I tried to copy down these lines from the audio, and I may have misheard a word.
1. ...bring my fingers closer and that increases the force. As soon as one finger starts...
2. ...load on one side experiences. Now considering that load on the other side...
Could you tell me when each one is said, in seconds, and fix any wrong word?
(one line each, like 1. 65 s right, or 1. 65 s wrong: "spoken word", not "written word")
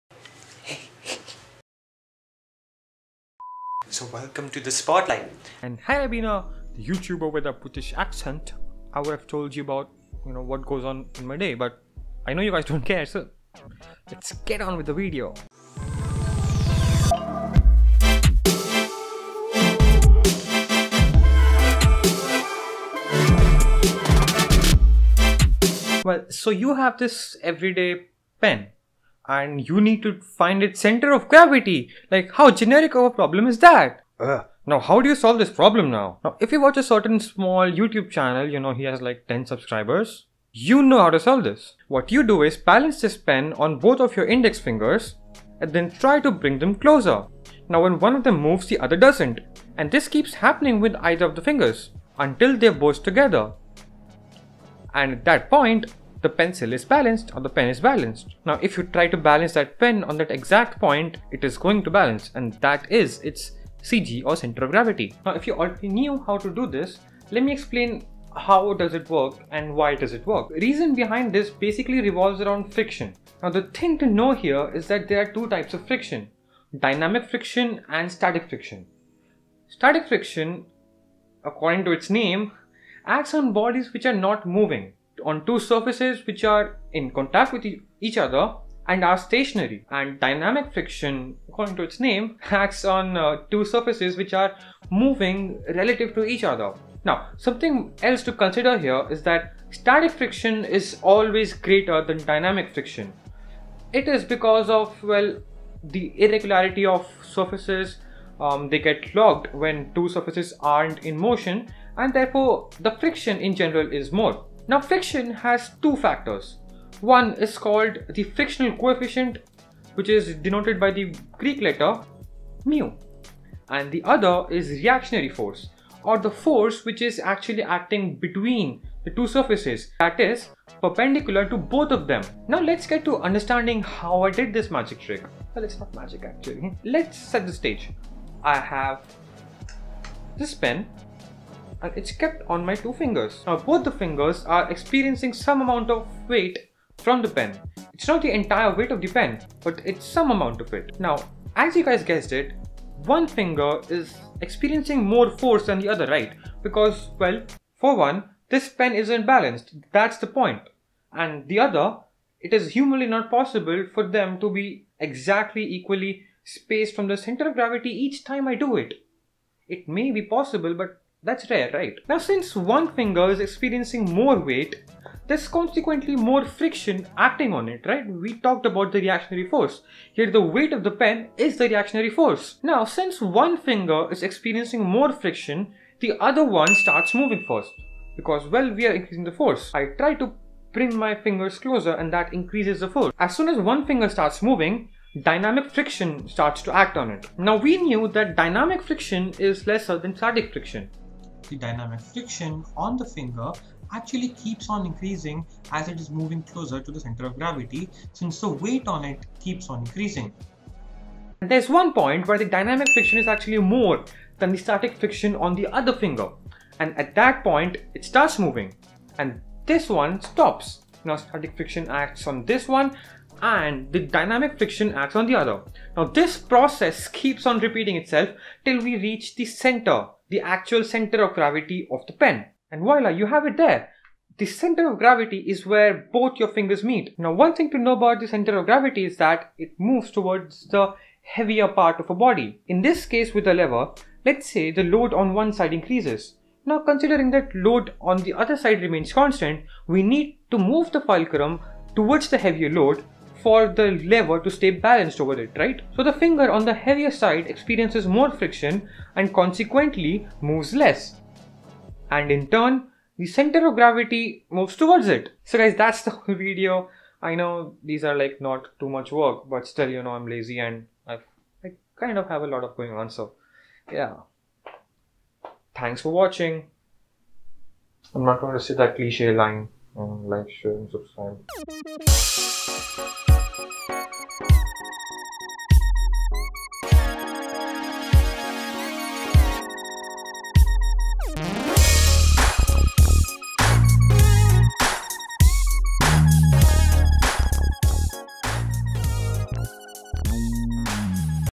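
1. 190 s right
2. 244 s wrong: "increases", not "experiences".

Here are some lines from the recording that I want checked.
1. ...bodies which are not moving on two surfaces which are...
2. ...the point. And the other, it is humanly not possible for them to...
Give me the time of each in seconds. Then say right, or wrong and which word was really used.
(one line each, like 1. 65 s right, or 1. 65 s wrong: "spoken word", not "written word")
1. 83 s right
2. 160 s right.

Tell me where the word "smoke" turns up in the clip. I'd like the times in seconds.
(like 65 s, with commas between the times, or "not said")
not said.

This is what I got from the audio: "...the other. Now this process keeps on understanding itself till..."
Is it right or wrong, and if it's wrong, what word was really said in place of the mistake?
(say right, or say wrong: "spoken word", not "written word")
wrong: "repeating", not "understanding".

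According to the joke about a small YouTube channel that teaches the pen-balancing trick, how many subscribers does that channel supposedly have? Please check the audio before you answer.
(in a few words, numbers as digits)
10.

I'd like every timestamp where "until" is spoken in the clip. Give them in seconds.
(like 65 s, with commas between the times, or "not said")
52 s.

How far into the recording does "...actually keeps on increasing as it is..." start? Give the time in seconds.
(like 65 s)
203 s.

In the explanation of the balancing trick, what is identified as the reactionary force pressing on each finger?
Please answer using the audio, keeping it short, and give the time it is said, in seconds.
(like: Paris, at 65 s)
The weight of the pen, at 180 s.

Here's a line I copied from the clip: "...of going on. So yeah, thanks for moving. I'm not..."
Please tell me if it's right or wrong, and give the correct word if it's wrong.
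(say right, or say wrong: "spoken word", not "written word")
wrong: "watching", not "moving".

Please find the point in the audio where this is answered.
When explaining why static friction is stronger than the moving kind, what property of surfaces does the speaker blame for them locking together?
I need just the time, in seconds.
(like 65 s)
106 s.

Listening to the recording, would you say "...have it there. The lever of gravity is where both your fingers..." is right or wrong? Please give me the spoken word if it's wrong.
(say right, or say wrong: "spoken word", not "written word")
wrong: "center", not "lever".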